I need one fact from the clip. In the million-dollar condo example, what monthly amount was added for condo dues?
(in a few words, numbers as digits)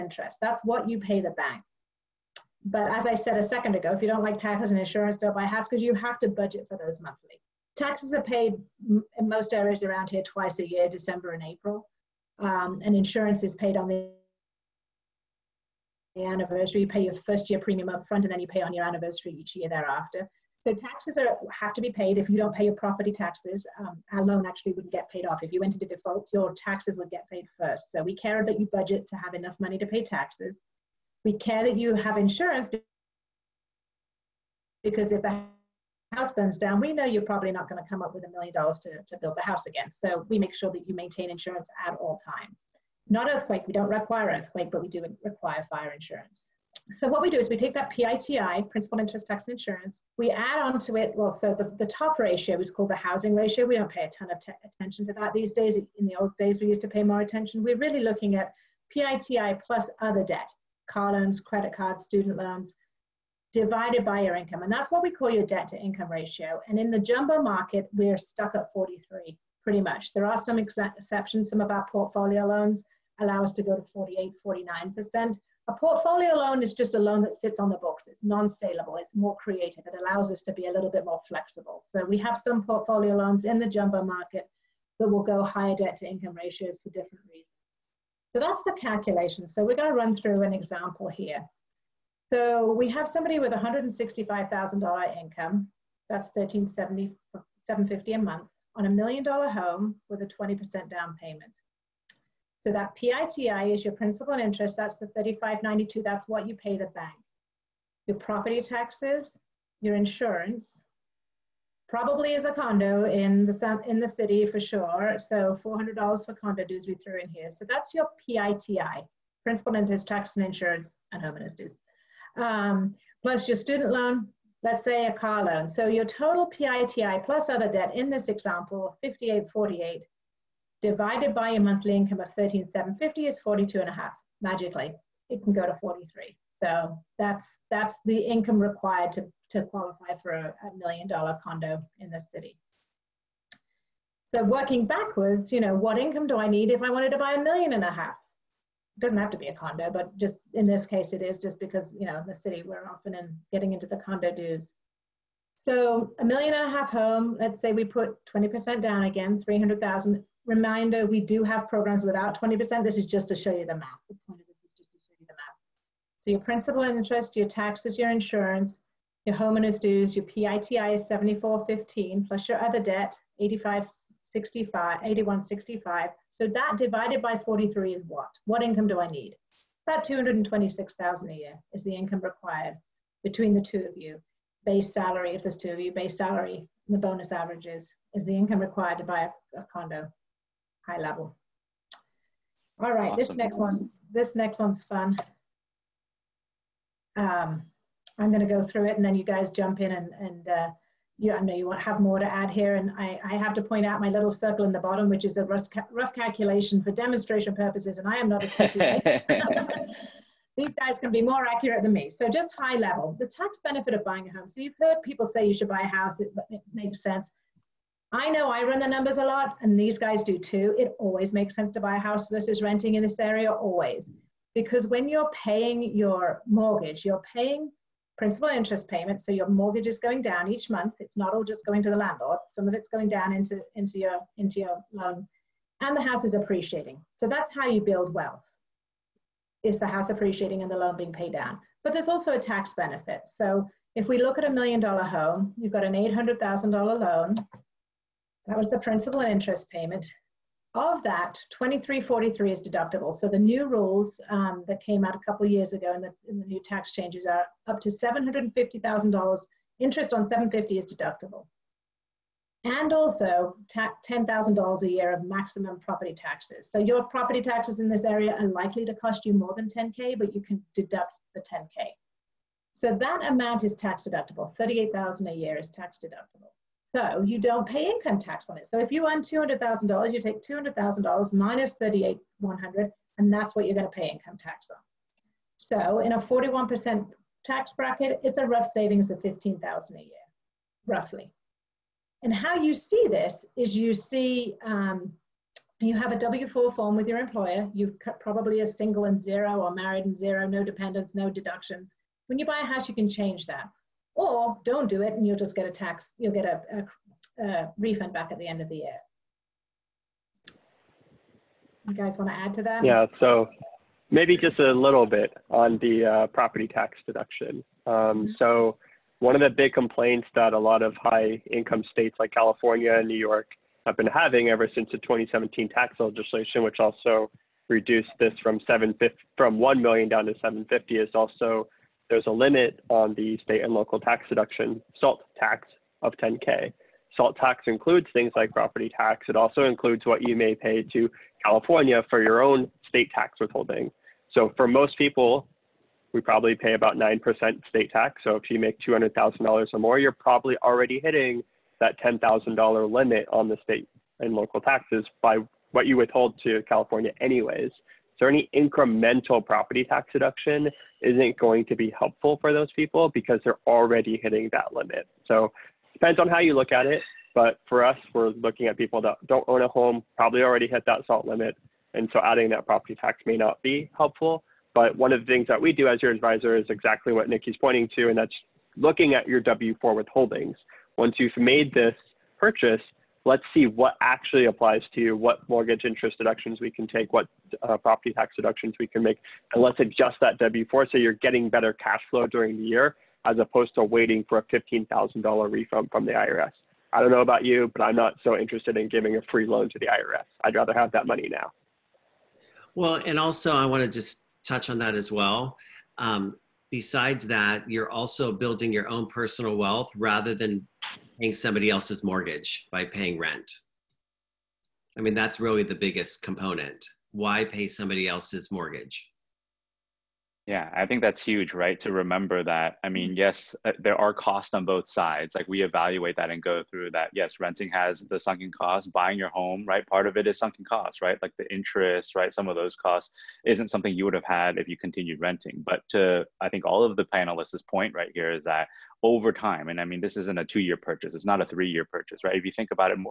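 $400.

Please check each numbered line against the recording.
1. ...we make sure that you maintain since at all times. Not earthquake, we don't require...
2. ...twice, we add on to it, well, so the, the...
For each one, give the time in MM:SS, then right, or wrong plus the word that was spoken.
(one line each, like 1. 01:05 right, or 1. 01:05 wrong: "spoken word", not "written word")
1. 00:40 wrong: "insurance", not "since"
2. 00:49 wrong: "insurance", not "twice".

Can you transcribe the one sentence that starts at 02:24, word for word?
So working backwards, you know, what income do I need if I wanted to buy a million and a half?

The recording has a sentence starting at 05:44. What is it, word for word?
So for most people, we probably pay about 9% state tax.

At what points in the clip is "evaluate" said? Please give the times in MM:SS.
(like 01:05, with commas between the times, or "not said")
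07:05.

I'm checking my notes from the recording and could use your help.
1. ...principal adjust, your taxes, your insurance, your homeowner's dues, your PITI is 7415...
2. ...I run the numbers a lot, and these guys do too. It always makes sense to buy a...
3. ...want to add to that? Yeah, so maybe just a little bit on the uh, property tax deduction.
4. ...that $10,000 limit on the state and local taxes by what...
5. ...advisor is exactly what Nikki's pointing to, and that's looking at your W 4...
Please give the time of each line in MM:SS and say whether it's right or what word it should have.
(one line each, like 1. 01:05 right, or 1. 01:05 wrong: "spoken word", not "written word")
1. 02:46 wrong: "interest", not "adjust"
2. 03:38 right
3. 05:12 right
4. 05:51 right
5. 06:16 right.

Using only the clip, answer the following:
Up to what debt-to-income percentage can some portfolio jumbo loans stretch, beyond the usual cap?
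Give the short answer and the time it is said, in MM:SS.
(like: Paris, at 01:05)
48, 49%, at 01:13.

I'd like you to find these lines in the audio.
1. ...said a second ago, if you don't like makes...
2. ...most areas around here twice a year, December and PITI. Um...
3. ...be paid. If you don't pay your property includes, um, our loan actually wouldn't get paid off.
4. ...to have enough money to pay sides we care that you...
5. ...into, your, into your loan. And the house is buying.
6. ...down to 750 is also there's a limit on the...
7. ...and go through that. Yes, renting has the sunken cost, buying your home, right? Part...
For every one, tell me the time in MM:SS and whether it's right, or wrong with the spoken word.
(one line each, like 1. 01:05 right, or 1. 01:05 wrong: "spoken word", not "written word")
1. 00:03 wrong: "taxes", not "makes"
2. 00:09 wrong: "April", not "PITI"
3. 00:21 wrong: "taxes", not "includes"
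4. 00:29 wrong: "taxes", not "sides"
5. 03:53 wrong: "appreciating", not "buying"
6. 05:30 right
7. 07:06 right.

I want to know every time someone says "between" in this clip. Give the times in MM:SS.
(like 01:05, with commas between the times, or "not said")
03:03.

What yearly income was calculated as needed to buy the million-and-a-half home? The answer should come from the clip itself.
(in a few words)
226,000.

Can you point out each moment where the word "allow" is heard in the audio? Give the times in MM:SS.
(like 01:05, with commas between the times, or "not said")
01:13, 01:19.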